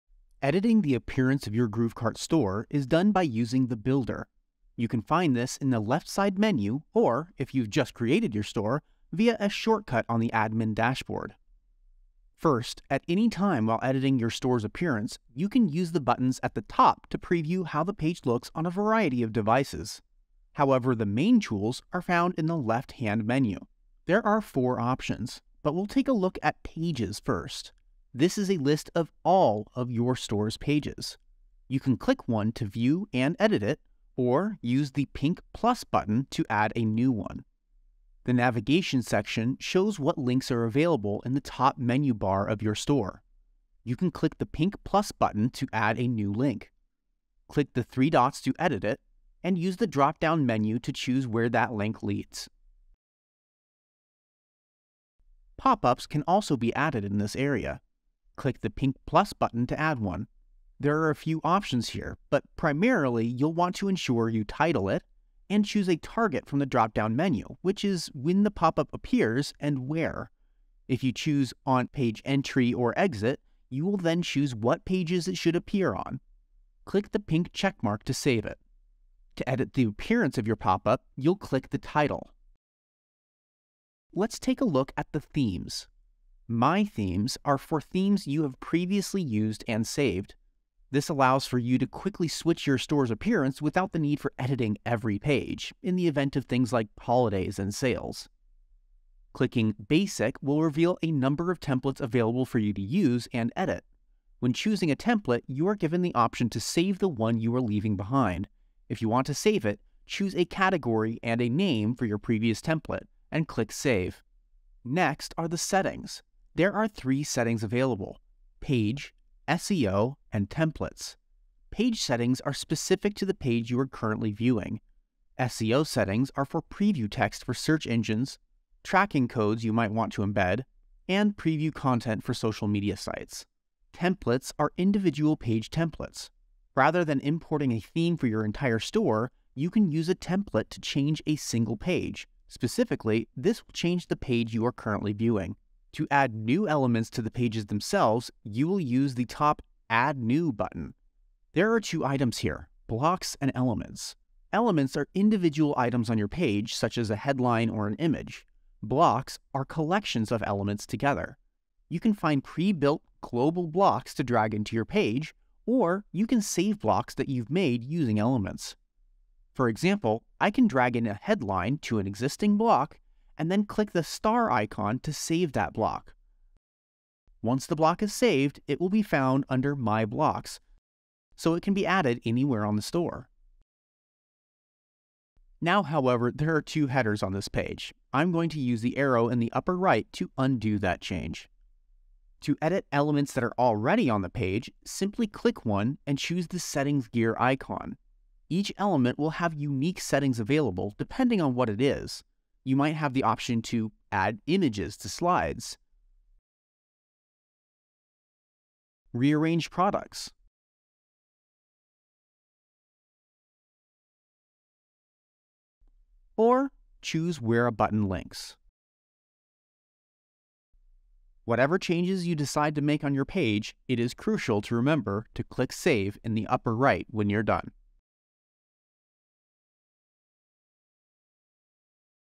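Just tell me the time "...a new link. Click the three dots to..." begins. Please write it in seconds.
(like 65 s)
45 s.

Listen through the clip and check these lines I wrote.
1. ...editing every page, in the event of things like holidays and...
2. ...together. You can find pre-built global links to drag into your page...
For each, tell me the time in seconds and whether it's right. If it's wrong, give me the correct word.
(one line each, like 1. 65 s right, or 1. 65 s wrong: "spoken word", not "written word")
1. 94 s right
2. 160 s wrong: "blocks", not "links".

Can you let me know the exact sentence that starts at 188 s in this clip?
I'm going to use the arrow in the upper right to undo that change.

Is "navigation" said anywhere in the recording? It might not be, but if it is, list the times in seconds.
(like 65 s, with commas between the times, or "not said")
38 s.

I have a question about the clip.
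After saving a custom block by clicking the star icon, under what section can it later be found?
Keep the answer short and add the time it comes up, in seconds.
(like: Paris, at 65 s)
My Blocks, at 179 s.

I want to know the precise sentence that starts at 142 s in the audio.
Specifically, this will change the page you are currently viewing.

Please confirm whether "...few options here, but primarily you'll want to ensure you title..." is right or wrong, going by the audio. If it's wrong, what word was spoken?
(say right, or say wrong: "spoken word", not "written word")
right.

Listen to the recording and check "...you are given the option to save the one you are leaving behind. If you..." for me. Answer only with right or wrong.
right.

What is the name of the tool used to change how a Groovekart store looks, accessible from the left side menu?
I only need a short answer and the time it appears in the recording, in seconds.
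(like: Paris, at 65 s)
Builder, at 3 s.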